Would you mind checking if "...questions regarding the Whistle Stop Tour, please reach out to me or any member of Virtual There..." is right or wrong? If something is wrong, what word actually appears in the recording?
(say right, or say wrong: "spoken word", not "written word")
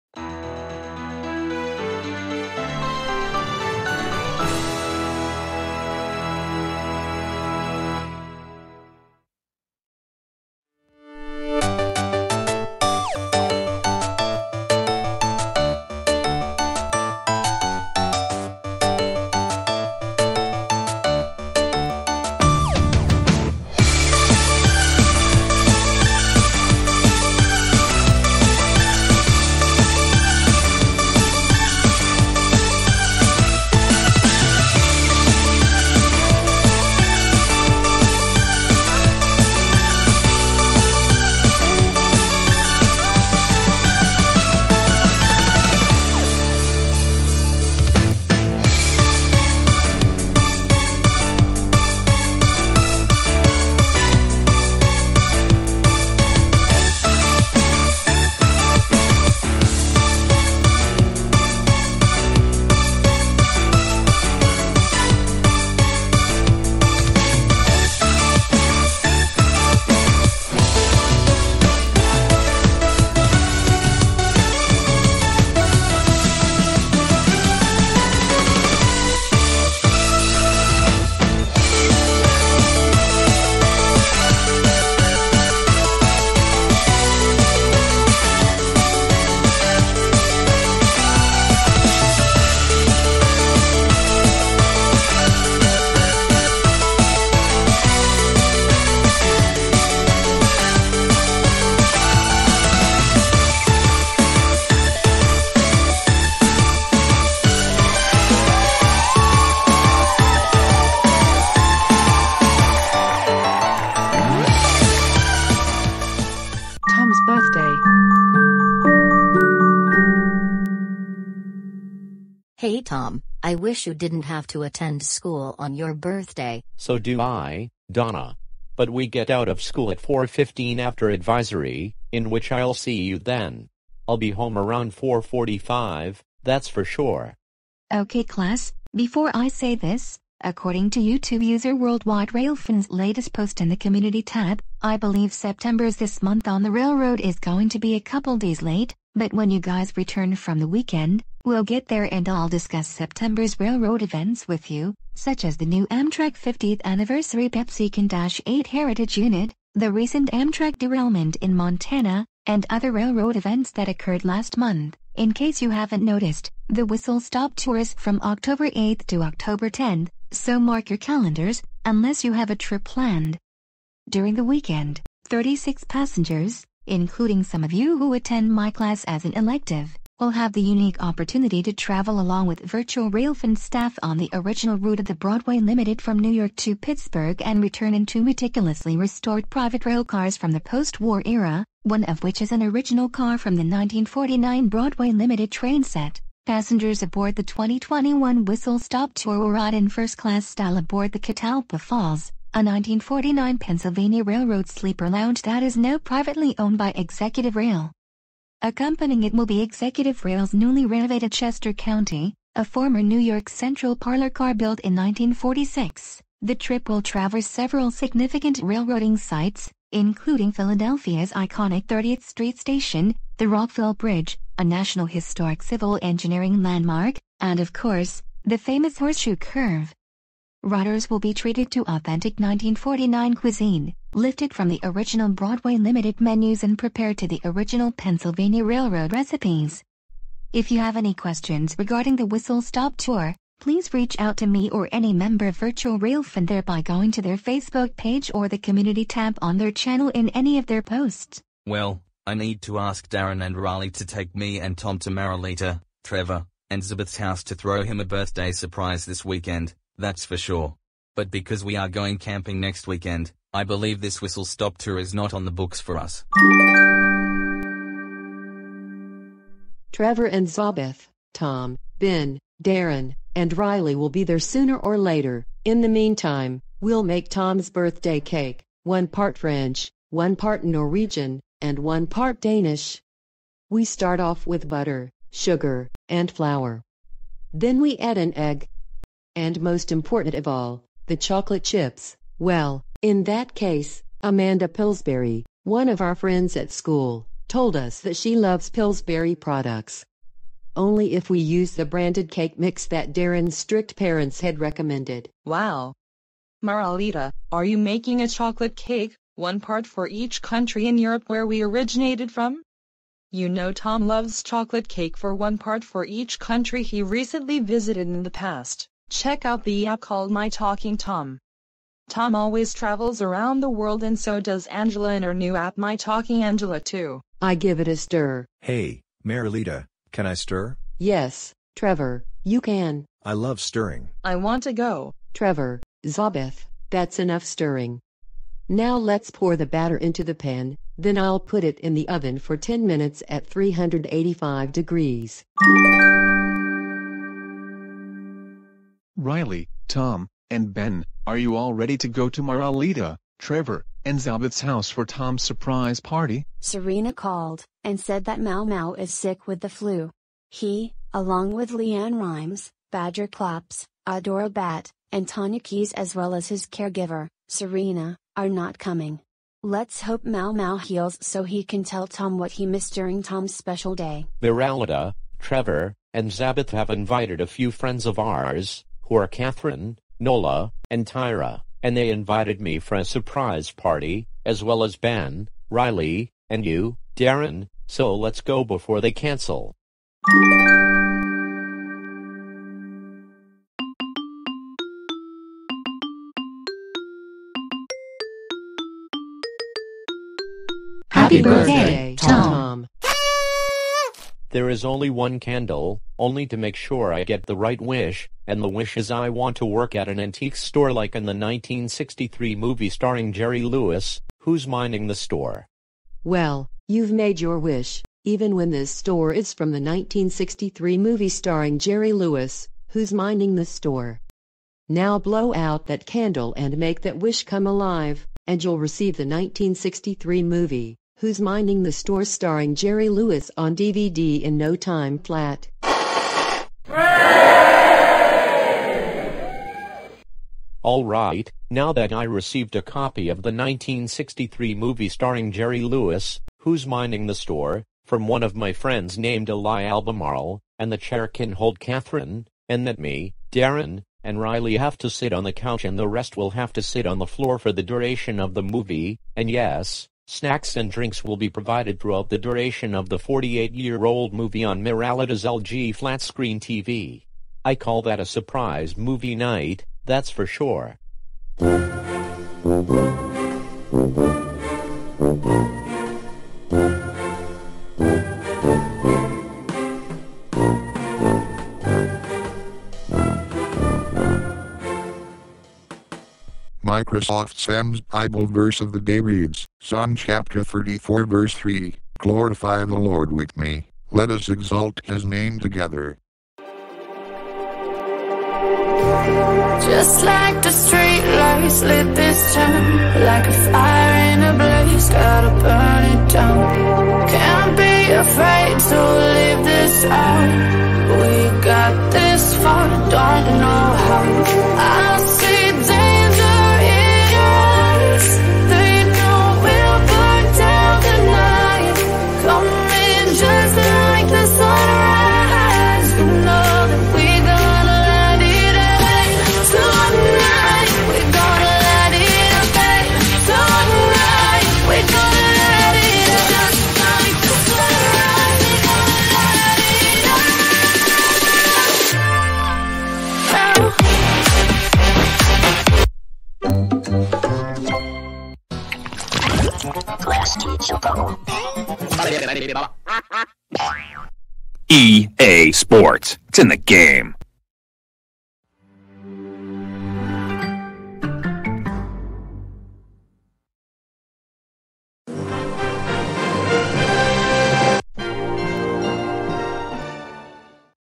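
right.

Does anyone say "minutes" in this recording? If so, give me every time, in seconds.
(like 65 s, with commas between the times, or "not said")
342 s.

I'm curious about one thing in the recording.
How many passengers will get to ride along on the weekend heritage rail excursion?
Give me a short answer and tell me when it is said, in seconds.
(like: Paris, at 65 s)
36, at 175 s.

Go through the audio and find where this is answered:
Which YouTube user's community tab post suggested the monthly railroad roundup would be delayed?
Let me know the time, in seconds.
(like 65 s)
141 s.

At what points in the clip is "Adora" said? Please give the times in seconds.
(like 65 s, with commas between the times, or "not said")
364 s.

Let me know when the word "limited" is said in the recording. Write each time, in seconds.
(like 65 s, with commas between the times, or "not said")
185 s, 195 s, 235 s.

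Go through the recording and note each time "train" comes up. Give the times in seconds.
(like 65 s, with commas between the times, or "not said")
195 s.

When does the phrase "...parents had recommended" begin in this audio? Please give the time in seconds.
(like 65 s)
303 s.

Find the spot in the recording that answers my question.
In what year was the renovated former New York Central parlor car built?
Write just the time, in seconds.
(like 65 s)
214 s.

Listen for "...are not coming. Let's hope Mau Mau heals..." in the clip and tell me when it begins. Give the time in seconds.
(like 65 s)
368 s.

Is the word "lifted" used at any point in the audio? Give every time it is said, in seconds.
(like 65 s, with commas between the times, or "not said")
234 s.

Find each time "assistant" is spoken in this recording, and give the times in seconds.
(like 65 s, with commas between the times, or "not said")
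not said.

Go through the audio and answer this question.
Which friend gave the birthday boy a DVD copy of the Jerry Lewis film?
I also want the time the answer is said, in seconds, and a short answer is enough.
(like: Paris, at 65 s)
Eli Albemarle, at 449 s.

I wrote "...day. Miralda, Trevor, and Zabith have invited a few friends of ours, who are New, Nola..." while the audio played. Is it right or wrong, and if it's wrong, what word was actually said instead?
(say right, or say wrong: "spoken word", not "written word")
wrong: "Kathryn", not "New".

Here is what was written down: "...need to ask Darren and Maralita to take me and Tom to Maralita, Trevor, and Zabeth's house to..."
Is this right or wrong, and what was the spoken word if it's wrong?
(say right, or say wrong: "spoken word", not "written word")
wrong: "Riley", not "Maralita".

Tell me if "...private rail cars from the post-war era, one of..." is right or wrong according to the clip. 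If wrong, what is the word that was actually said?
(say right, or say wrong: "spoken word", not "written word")
right.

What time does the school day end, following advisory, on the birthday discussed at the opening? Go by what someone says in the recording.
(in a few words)
4:15.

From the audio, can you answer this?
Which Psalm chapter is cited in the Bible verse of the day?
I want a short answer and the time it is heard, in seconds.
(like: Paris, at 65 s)
34, at 490 s.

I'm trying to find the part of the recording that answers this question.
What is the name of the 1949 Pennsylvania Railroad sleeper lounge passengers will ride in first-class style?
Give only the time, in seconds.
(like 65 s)
201 s.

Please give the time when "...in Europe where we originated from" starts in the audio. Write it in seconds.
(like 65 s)
310 s.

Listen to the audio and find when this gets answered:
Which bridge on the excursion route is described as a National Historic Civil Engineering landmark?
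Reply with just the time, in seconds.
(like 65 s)
223 s.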